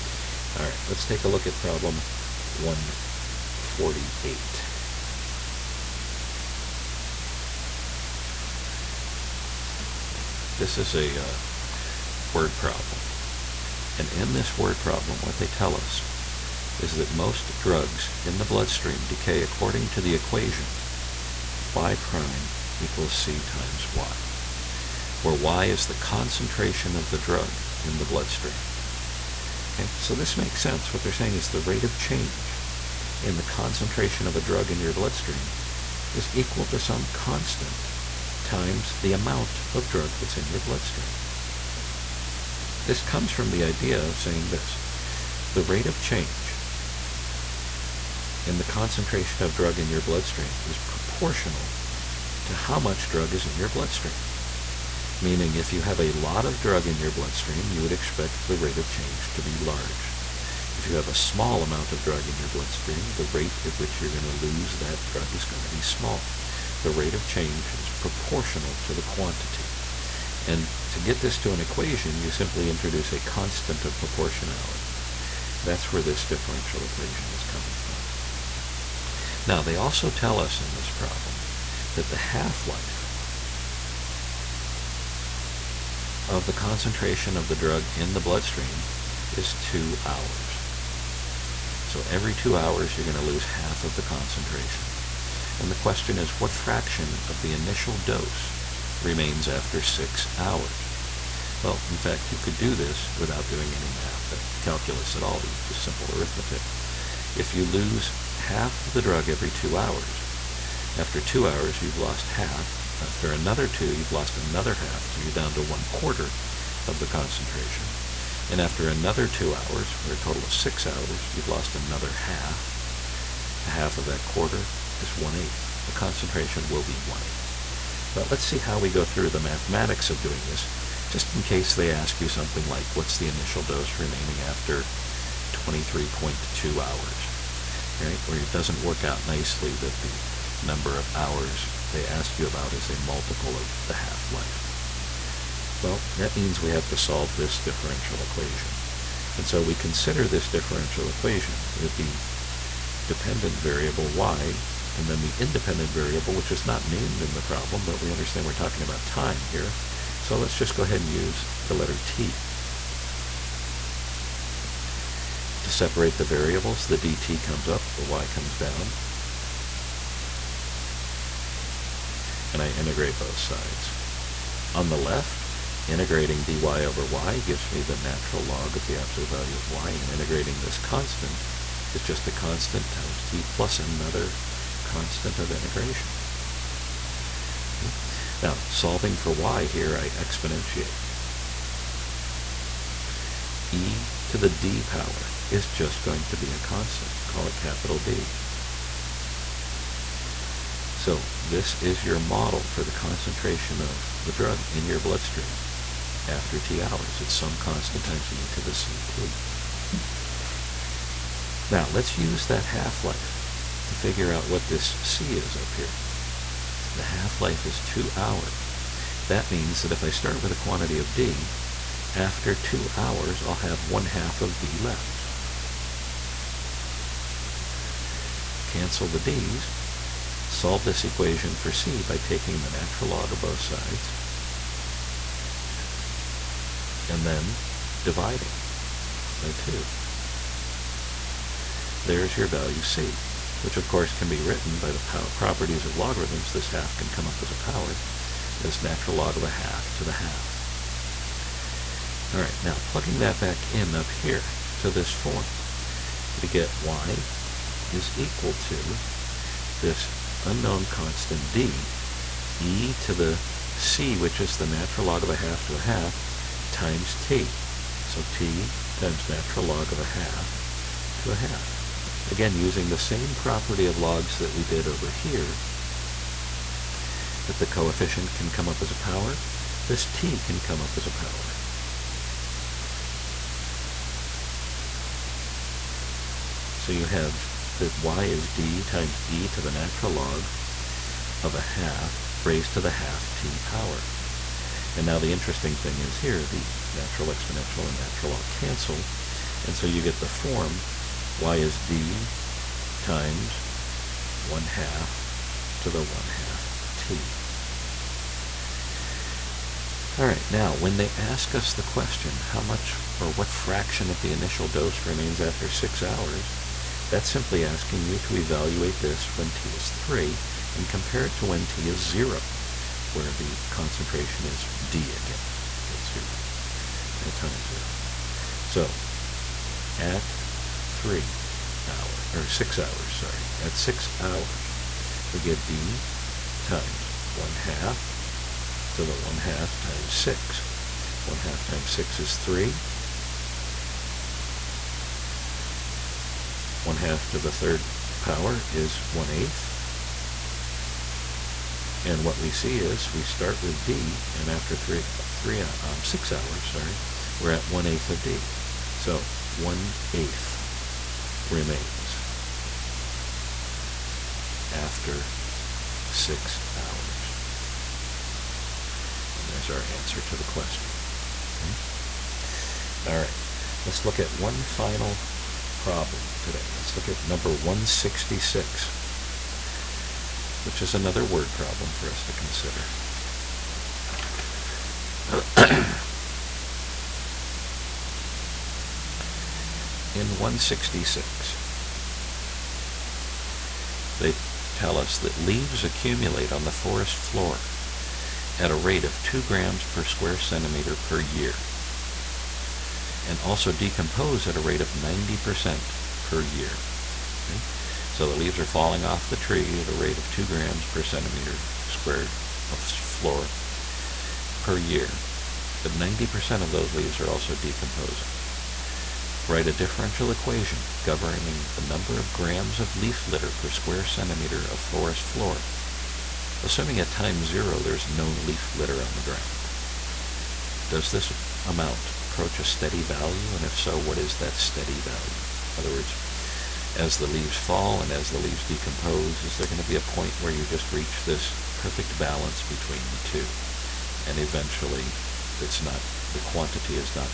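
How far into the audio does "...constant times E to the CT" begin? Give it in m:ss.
3:27.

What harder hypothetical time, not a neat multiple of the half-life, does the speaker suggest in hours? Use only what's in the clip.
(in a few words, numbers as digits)
23.2.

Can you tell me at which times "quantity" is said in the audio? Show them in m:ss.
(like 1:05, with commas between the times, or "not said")
1:09, 3:40, 7:26.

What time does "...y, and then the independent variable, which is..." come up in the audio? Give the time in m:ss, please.
2:34.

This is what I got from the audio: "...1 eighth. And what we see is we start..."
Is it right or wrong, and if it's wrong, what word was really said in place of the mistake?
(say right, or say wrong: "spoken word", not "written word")
right.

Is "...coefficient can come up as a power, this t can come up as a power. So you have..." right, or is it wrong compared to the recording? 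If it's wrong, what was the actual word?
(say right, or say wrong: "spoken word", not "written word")
right.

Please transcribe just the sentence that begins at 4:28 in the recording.
So t times natural log of a half to a half.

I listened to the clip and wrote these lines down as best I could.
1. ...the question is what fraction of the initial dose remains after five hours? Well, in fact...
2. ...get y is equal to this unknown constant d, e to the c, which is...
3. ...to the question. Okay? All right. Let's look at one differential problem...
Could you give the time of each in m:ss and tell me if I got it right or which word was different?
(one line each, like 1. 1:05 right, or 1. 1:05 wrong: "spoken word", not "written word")
1. 1:35 wrong: "six", not "five"
2. 4:16 right
3. 6:10 wrong: "final", not "differential".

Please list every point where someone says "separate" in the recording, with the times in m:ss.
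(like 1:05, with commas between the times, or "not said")
2:45.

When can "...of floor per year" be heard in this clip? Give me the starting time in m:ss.
6:52.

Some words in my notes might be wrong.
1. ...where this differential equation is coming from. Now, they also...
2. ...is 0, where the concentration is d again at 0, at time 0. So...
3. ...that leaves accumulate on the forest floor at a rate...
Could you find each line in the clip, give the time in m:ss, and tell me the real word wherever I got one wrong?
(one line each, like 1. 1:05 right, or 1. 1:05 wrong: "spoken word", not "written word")
1. 1:15 right
2. 5:21 right
3. 6:35 right.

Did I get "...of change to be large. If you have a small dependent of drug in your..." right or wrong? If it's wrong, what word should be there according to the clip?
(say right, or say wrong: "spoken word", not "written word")
wrong: "amount", not "dependent".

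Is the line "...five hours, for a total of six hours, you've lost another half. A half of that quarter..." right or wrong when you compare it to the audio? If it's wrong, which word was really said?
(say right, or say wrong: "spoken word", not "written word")
wrong: "two", not "five".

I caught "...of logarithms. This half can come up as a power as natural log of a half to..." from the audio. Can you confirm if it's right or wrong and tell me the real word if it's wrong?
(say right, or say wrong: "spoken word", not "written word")
right.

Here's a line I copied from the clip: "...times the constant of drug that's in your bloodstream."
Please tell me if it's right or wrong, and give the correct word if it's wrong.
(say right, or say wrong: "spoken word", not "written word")
wrong: "amount", not "constant".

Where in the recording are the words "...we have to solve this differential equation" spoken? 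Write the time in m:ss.
2:26.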